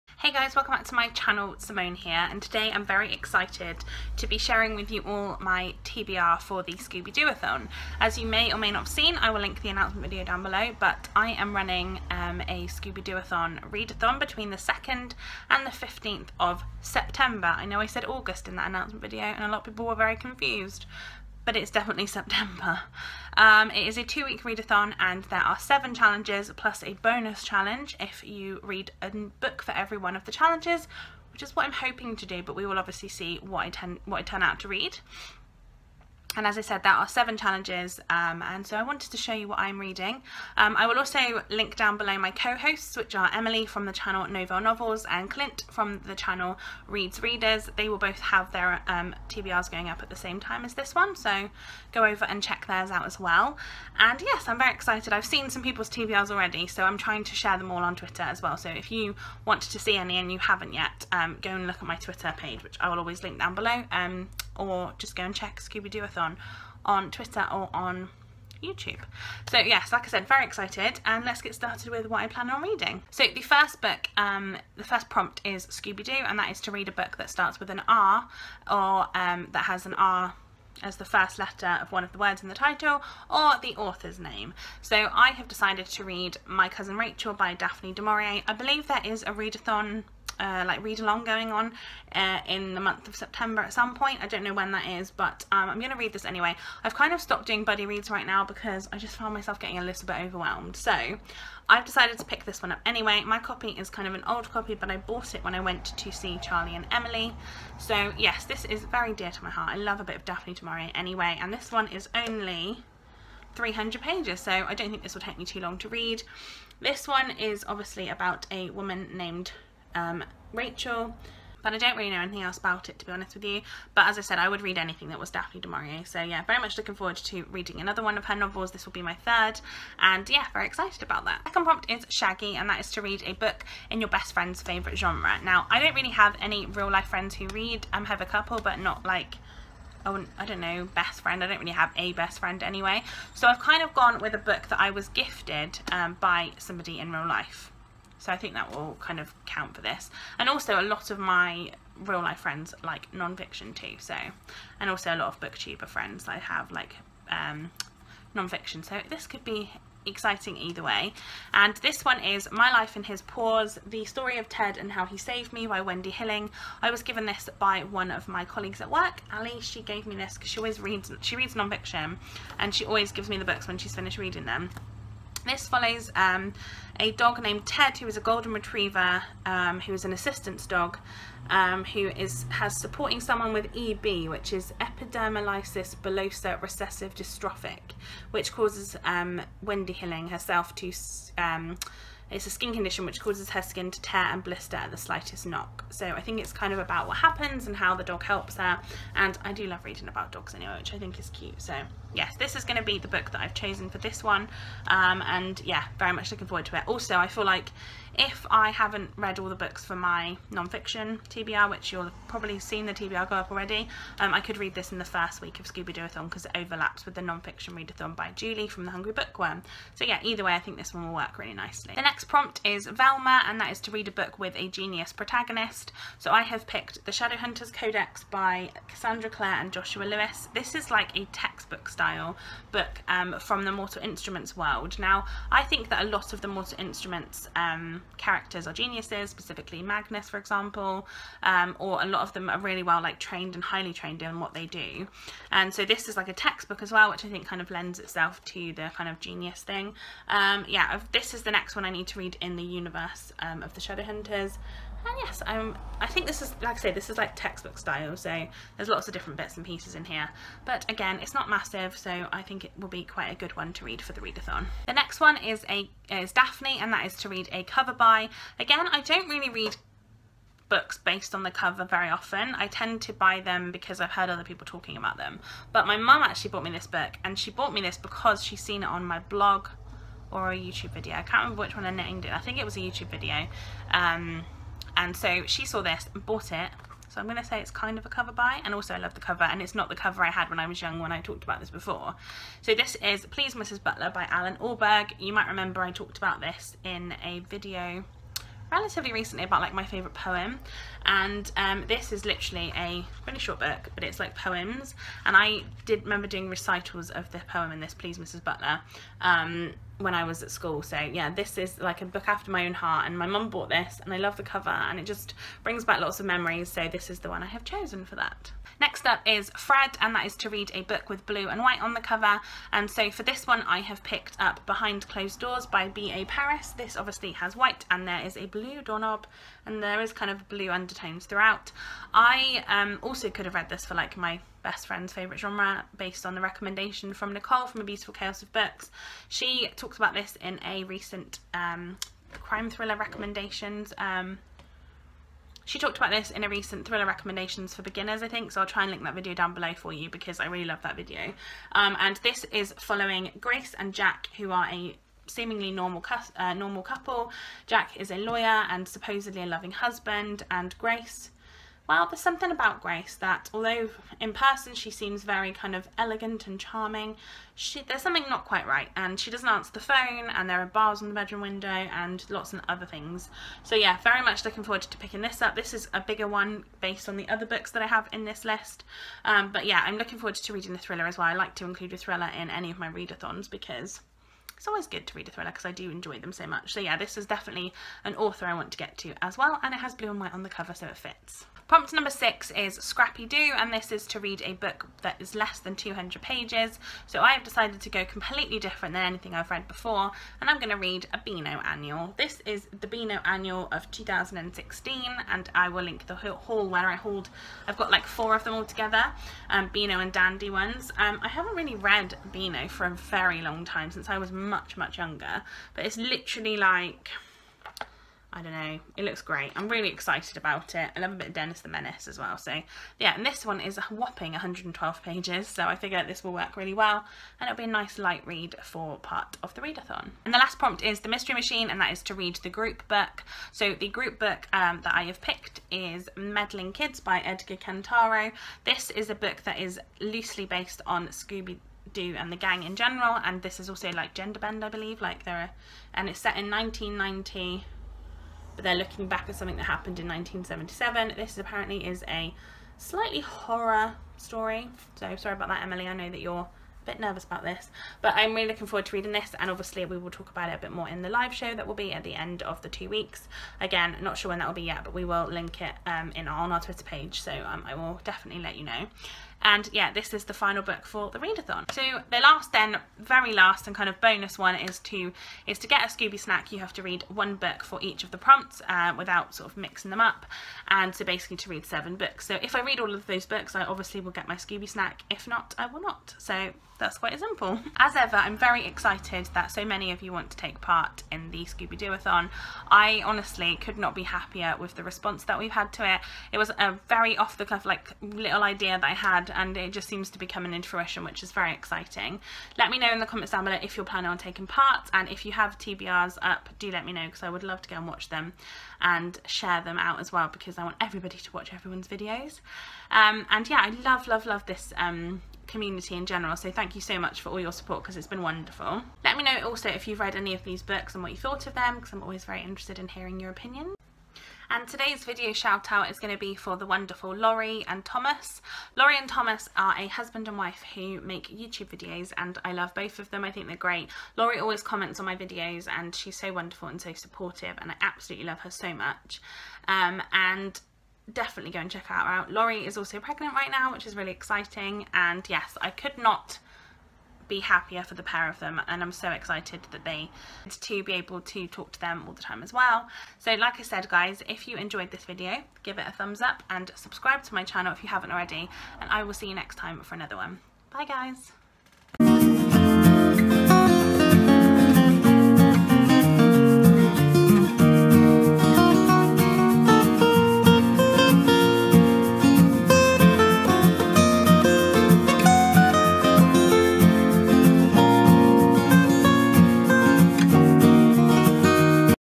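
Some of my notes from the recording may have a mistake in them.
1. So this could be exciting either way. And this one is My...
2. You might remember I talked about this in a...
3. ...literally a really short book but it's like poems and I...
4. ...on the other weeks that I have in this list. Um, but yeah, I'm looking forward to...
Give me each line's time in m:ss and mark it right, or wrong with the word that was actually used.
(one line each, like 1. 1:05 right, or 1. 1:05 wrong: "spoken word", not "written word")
1. 2:38 right
2. 4:55 right
3. 5:02 right
4. 6:17 wrong: "books", not "weeks".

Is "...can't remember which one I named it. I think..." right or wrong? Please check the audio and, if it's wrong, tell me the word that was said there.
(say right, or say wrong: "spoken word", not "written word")
right.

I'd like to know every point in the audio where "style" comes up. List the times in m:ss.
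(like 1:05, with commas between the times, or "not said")
3:51, 4:17.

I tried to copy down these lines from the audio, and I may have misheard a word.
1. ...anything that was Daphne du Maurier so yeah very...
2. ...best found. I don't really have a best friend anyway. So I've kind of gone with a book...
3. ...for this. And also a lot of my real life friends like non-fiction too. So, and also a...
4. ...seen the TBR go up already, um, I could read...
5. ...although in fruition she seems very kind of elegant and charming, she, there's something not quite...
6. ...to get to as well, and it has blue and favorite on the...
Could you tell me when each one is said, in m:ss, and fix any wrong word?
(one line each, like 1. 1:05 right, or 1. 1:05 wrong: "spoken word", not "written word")
1. 2:04 right
2. 2:20 wrong: "friend", not "found"
3. 2:29 right
4. 3:32 right
5. 6:03 wrong: "person", not "fruition"
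6. 6:28 wrong: "white", not "favorite".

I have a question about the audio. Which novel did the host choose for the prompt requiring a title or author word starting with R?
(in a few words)
My Cousin Rachel.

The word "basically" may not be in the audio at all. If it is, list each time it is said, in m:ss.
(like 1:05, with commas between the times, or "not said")
8:01.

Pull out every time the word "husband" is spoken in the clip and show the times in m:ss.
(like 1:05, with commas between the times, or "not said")
5:59, 8:49.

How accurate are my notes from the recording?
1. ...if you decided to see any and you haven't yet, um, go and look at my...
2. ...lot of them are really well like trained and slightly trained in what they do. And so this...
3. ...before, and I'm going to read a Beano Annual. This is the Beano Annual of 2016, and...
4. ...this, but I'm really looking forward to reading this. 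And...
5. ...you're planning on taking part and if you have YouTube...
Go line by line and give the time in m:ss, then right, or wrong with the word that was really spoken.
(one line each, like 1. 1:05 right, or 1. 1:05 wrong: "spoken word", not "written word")
1. 0:58 wrong: "wanted", not "decided"
2. 4:02 wrong: "highly", not "slightly"
3. 6:39 right
4. 7:37 right
5. 8:23 wrong: "TBRs", not "YouTube".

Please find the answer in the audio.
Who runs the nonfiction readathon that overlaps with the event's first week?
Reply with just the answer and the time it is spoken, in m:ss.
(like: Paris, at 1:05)
Julie, at 3:38.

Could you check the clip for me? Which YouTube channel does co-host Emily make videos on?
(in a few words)
Novelle Novels.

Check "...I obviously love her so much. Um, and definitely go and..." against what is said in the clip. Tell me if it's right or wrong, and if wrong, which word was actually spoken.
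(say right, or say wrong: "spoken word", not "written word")
wrong: "absolutely", not "obviously".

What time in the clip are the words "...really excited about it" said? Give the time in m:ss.
6:59.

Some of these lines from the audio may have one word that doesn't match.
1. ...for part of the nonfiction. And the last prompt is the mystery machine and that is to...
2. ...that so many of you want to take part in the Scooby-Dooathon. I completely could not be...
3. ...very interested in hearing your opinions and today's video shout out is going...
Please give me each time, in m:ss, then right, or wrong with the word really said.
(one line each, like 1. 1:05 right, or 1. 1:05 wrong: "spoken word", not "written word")
1. 7:08 wrong: "readathon", not "nonfiction"
2. 8:09 wrong: "honestly", not "completely"
3. 8:42 right.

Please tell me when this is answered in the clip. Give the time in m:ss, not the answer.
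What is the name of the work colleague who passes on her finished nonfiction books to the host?
2:49.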